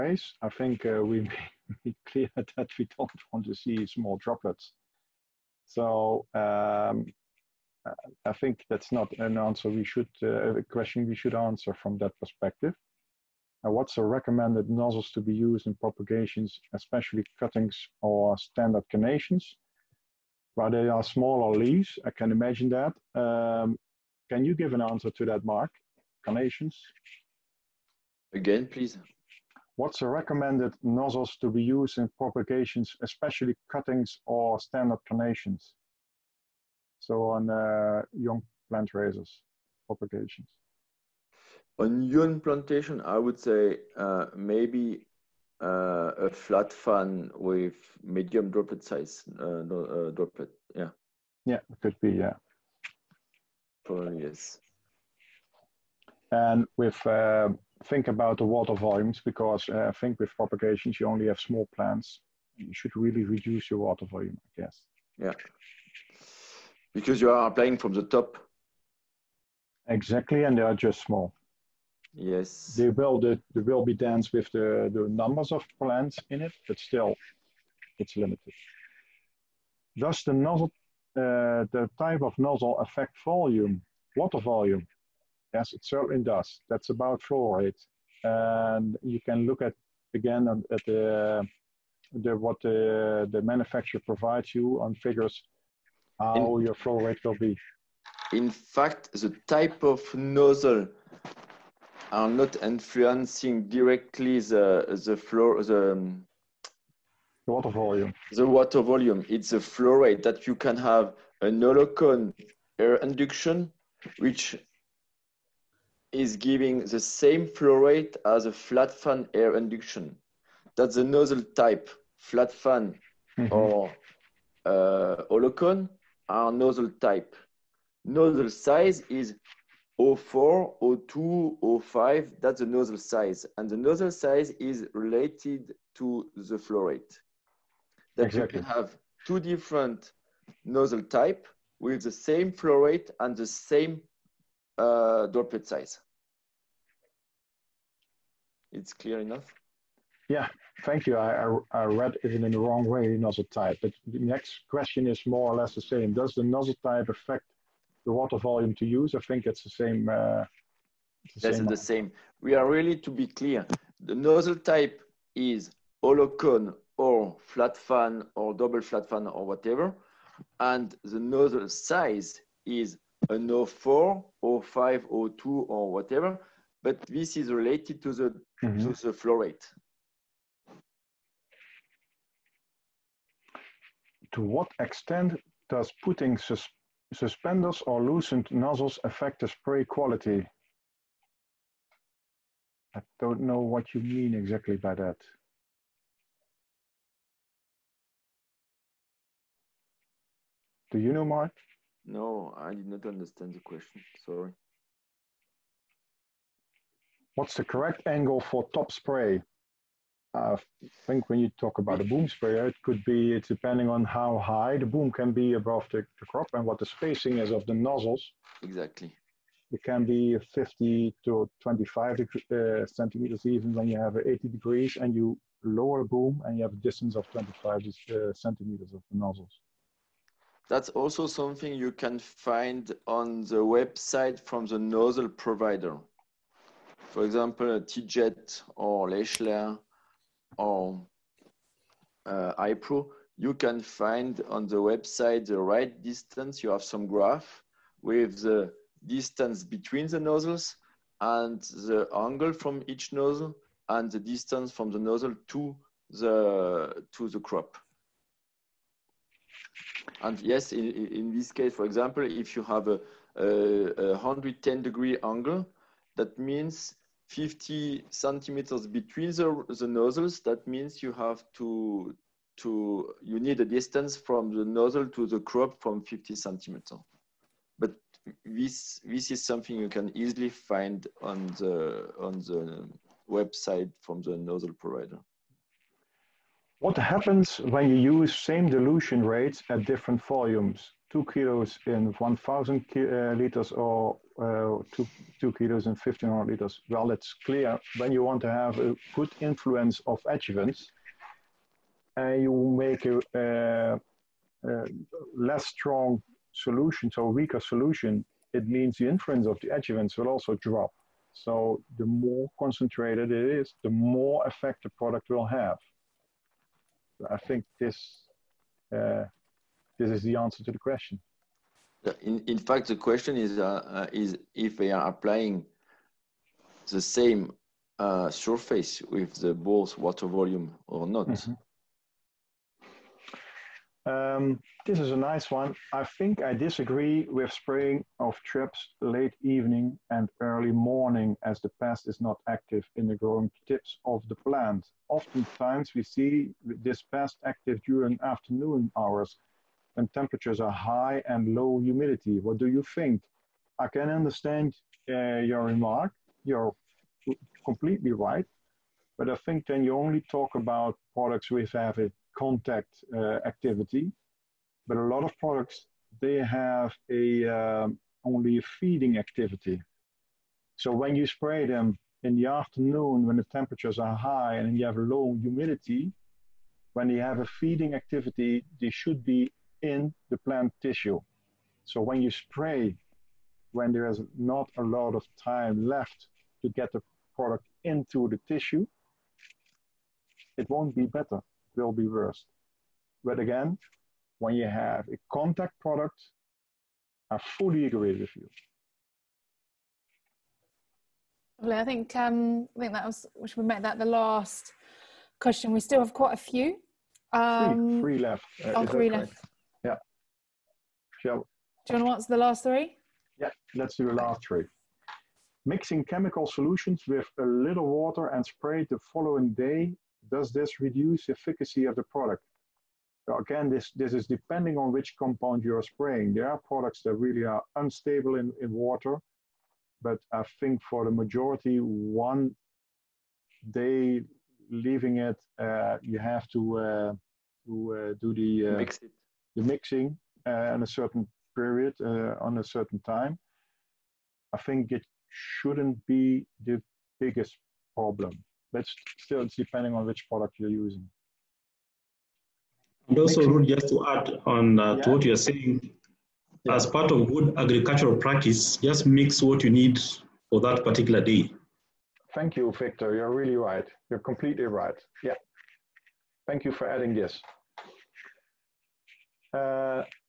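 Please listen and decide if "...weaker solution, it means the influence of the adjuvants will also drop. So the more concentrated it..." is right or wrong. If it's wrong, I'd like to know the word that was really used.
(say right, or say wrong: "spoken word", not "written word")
right.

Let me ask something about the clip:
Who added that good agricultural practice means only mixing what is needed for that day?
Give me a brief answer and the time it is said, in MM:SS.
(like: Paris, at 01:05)
Victor, at 07:42.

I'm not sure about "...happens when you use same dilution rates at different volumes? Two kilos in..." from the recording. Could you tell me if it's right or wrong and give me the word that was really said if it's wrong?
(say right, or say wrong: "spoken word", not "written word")
right.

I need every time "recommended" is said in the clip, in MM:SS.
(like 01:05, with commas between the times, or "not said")
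00:14, 00:30.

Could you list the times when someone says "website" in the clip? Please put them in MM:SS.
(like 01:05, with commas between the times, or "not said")
03:53, 04:04, 04:43.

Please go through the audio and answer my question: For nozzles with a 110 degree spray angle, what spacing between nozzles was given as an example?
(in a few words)
50 centimeters.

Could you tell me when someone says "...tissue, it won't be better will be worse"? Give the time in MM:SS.
06:28.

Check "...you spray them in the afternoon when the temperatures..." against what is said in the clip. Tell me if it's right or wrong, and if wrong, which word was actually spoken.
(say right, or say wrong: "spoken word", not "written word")
right.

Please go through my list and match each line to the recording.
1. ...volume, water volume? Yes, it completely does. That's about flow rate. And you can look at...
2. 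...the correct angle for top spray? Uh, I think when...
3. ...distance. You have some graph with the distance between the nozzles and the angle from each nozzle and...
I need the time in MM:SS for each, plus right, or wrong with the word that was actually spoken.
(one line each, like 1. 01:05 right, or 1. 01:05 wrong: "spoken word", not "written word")
1. 01:23 wrong: "certainly", not "completely"
2. 03:27 right
3. 04:06 right.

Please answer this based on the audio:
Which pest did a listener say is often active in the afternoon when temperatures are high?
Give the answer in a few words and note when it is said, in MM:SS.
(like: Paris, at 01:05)
Thrips, at 05:38.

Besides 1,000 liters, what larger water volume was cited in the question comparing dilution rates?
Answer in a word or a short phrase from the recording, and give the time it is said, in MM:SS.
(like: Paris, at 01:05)
1,500 liters, at 04:55.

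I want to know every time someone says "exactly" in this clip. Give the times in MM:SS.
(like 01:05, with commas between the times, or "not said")
01:09, 02:18, 03:14, 03:38.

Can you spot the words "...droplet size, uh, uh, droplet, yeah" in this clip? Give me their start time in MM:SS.
00:48.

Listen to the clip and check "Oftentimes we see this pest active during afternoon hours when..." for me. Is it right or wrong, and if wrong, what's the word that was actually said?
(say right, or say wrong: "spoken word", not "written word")
right.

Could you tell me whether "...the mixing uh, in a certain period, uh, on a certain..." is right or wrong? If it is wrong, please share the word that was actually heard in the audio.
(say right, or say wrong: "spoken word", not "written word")
right.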